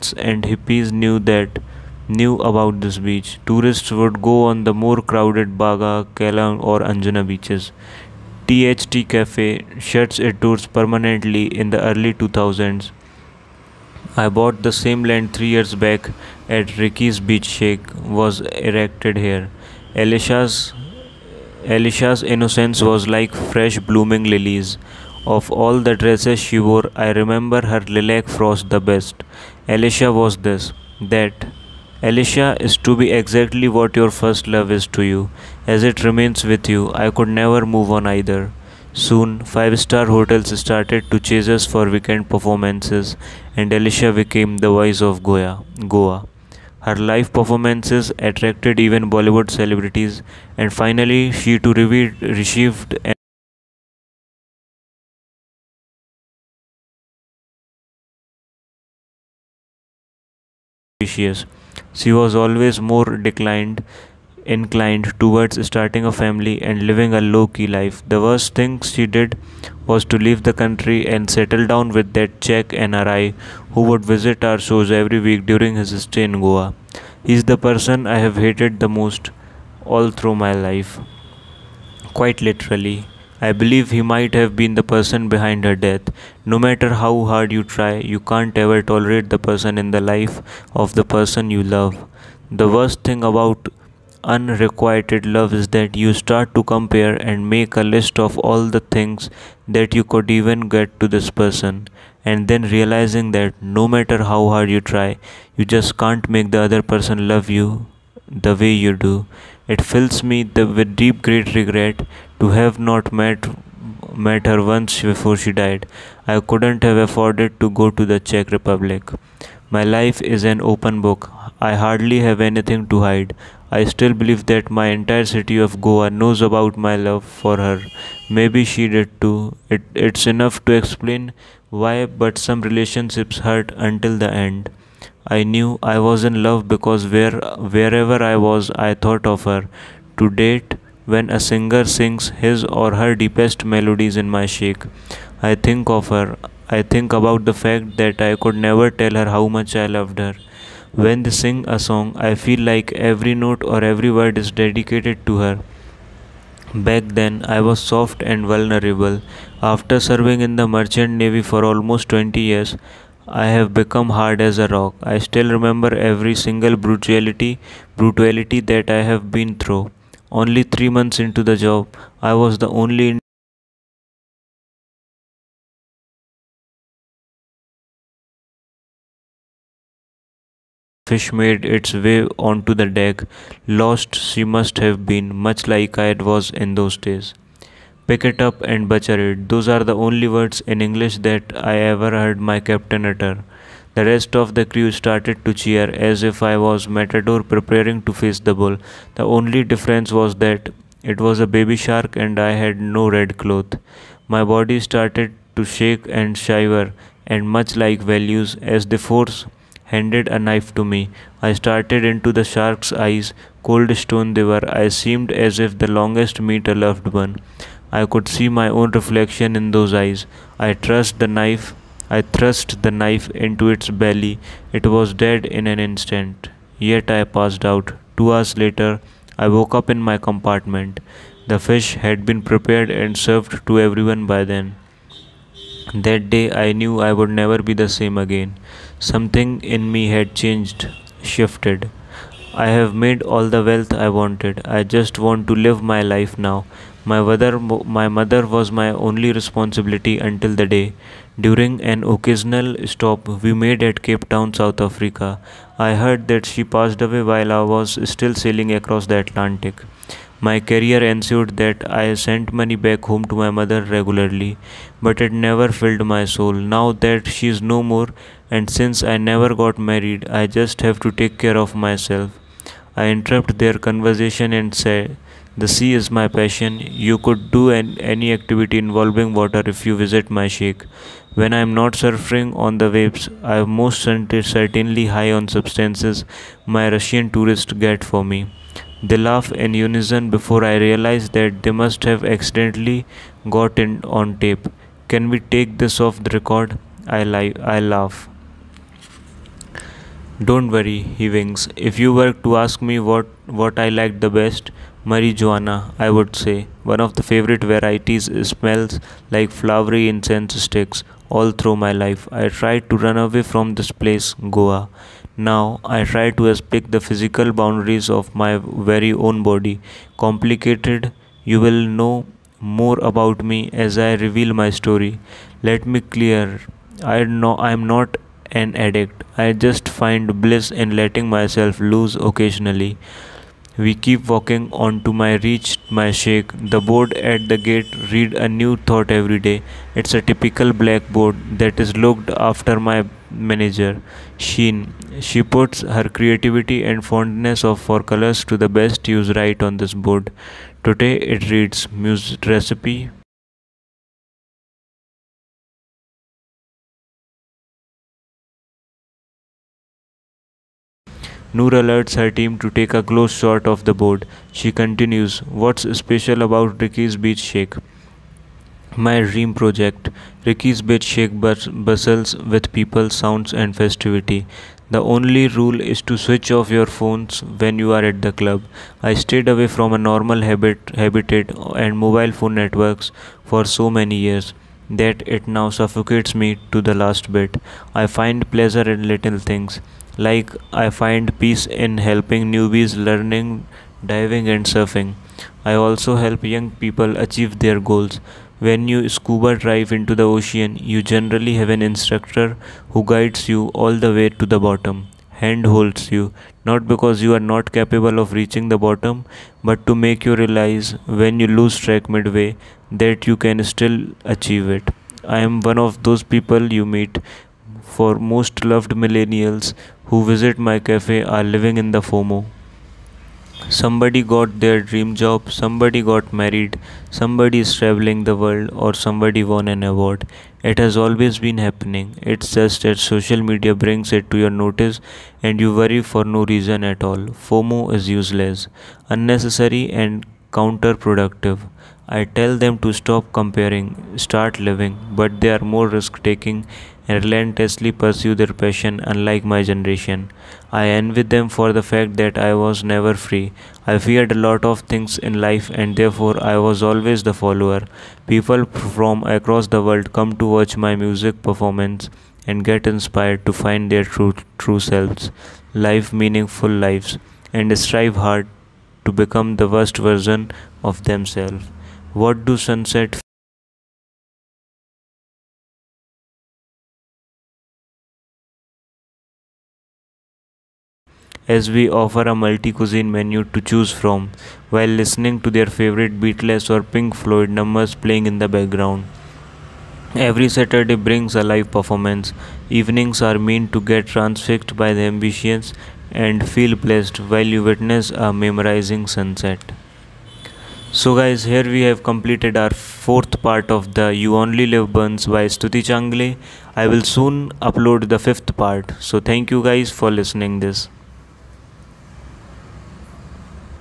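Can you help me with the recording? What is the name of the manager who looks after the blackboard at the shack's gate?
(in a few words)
Sheen.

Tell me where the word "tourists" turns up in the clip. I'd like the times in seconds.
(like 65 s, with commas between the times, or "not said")
3 s, 287 s.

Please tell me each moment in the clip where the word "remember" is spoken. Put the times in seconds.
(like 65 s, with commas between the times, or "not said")
27 s, 165 s.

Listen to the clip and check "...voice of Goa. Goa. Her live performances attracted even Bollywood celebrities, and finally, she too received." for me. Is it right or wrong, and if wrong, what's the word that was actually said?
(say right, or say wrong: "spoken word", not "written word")
right.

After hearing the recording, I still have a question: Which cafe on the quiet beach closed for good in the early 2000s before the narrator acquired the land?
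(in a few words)
THT Cafe.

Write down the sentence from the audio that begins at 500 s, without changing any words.
So guys, here we have completed our fourth part of the You Only Live Once by Stuti Changle.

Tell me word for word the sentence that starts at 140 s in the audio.
To date, when a singer sings his or her deepest melodies in my shake.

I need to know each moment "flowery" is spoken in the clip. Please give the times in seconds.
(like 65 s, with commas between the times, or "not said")
309 s.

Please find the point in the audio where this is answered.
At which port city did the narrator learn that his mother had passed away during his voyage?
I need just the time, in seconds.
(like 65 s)
254 s.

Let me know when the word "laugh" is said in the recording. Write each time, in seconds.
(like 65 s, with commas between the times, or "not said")
289 s, 297 s.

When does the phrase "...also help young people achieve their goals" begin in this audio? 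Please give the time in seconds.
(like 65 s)
395 s.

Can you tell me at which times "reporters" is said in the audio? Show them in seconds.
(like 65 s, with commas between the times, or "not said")
not said.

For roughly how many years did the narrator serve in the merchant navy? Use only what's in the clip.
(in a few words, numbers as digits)
20 years.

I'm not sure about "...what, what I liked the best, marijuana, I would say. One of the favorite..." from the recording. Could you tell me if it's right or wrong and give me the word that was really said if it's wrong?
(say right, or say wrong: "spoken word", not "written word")
right.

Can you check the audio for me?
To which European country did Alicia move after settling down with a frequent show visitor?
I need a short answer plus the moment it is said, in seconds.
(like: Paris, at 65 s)
Czech Republic, at 118 s.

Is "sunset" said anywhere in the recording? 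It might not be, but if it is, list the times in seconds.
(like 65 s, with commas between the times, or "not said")
472 s, 499 s.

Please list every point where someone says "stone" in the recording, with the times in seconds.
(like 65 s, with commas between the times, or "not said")
213 s.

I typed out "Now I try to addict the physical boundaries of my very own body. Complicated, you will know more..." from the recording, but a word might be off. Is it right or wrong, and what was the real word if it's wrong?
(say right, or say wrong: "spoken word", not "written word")
wrong: "aspect", not "addict".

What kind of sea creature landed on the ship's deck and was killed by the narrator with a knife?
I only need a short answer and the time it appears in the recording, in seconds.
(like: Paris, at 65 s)
baby shark, at 201 s.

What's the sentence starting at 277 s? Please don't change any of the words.
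You could do an, any activity involving water if you visit my shack.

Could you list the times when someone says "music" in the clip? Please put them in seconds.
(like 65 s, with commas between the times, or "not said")
351 s, 460 s.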